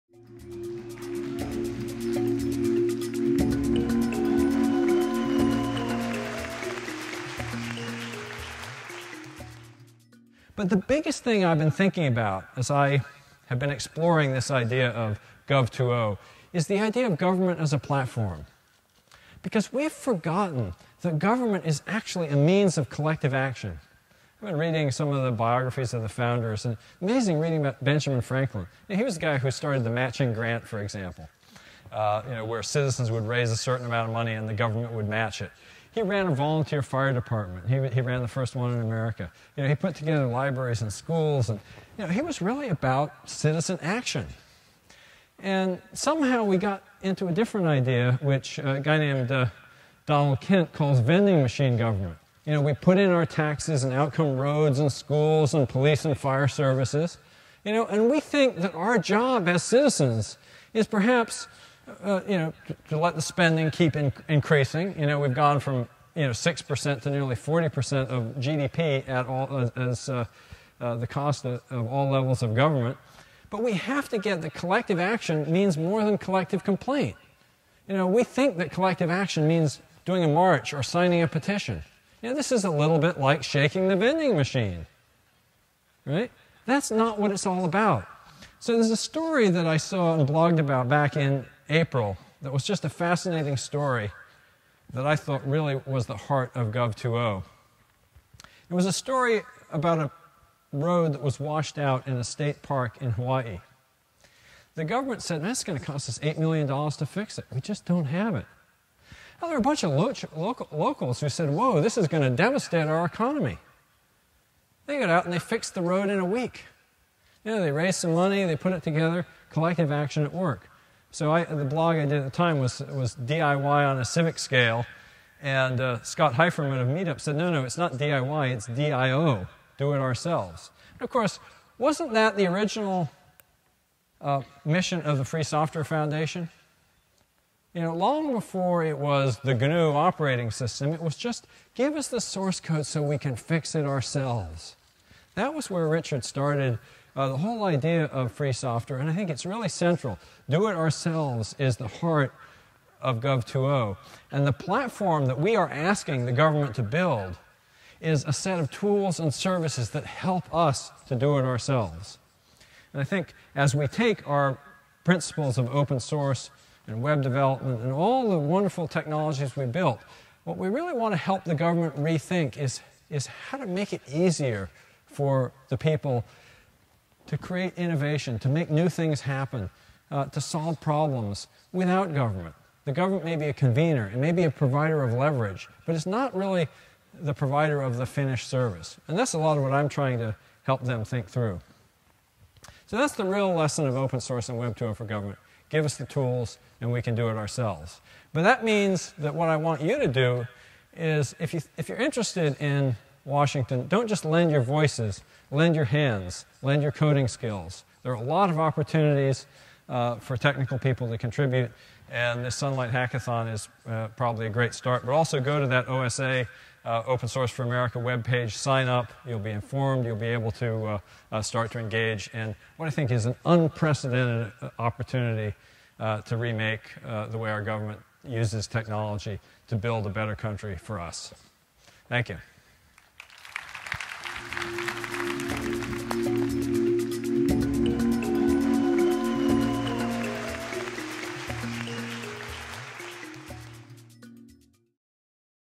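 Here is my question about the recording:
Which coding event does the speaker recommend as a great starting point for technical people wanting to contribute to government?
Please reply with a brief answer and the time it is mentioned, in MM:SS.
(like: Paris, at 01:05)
Sunlight Hackathon, at 03:32.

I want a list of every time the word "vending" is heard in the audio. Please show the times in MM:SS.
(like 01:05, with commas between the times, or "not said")
00:50, 01:23.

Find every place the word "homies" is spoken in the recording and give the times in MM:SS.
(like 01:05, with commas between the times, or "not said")
not said.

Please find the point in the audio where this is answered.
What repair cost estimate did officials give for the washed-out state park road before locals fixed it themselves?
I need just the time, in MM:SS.
01:46.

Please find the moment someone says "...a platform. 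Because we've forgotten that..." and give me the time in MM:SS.
00:17.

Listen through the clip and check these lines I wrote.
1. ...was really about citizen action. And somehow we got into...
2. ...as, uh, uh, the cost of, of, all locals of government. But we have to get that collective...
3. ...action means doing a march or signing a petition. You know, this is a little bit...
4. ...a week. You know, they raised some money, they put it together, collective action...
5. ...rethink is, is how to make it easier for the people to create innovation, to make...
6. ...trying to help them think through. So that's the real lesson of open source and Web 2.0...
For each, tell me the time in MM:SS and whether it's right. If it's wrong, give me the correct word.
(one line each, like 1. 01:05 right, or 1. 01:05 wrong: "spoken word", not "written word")
1. 00:42 right
2. 01:09 wrong: "levels", not "locals"
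3. 01:19 right
4. 01:56 right
5. 02:51 right
6. 03:09 right.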